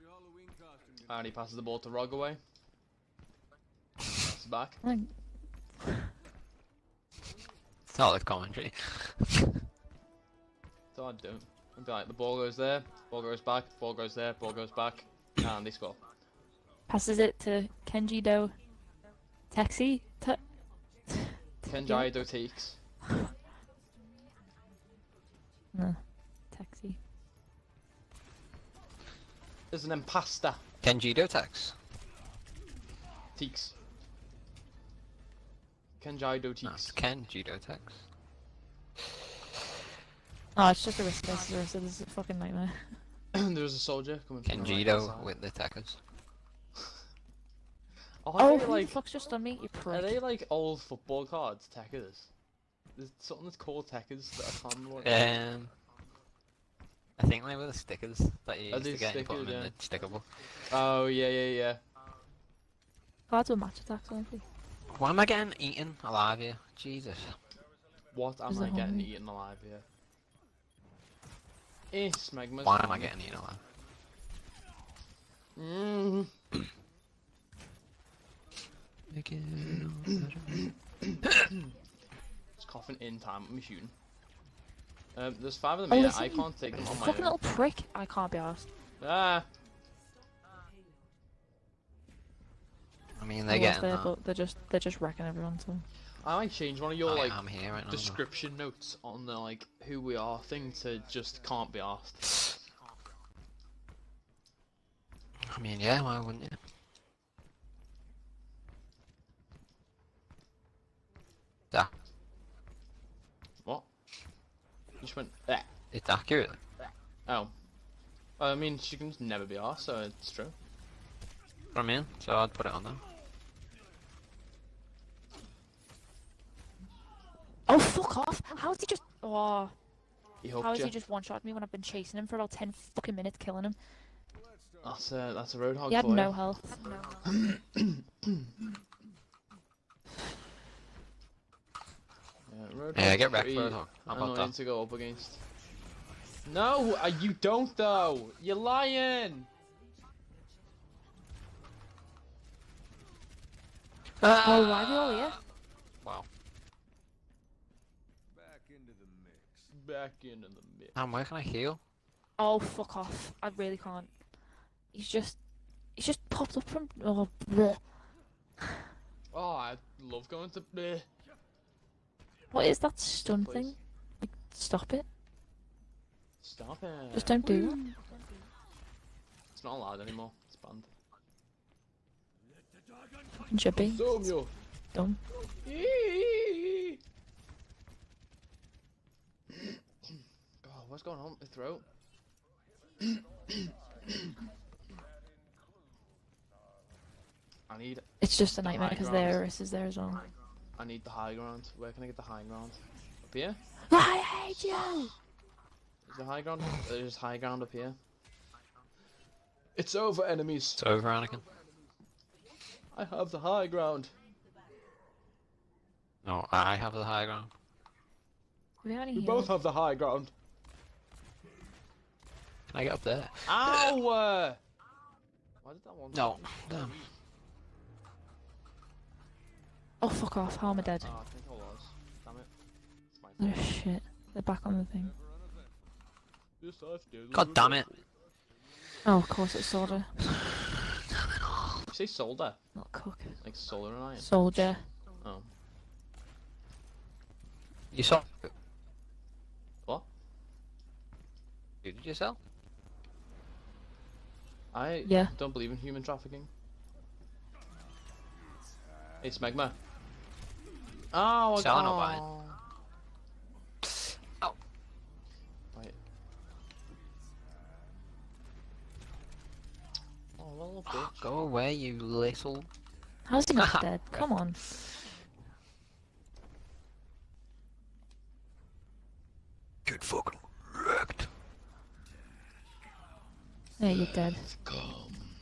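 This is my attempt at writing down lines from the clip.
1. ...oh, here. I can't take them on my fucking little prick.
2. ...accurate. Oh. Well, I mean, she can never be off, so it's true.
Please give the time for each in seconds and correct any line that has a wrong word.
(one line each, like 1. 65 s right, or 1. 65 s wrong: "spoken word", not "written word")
1. 85 s right
2. 116 s right.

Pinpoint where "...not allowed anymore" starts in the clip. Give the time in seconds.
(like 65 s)
179 s.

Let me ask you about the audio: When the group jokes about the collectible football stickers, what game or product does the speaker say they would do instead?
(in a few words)
Match Attack.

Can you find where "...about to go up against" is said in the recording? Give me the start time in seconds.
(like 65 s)
144 s.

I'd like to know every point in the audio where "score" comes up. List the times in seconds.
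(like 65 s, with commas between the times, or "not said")
15 s.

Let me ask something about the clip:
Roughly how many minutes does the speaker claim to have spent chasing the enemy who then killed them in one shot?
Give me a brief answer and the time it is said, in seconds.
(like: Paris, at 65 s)
10, at 132 s.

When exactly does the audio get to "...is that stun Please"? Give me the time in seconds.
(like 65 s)
172 s.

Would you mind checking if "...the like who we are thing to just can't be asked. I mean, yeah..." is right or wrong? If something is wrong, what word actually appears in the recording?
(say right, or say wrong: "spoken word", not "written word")
right.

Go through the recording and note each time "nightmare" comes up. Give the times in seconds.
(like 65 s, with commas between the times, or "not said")
42 s, 198 s.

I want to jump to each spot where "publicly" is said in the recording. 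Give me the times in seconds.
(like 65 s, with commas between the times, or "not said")
not said.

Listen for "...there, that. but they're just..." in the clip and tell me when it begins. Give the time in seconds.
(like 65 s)
93 s.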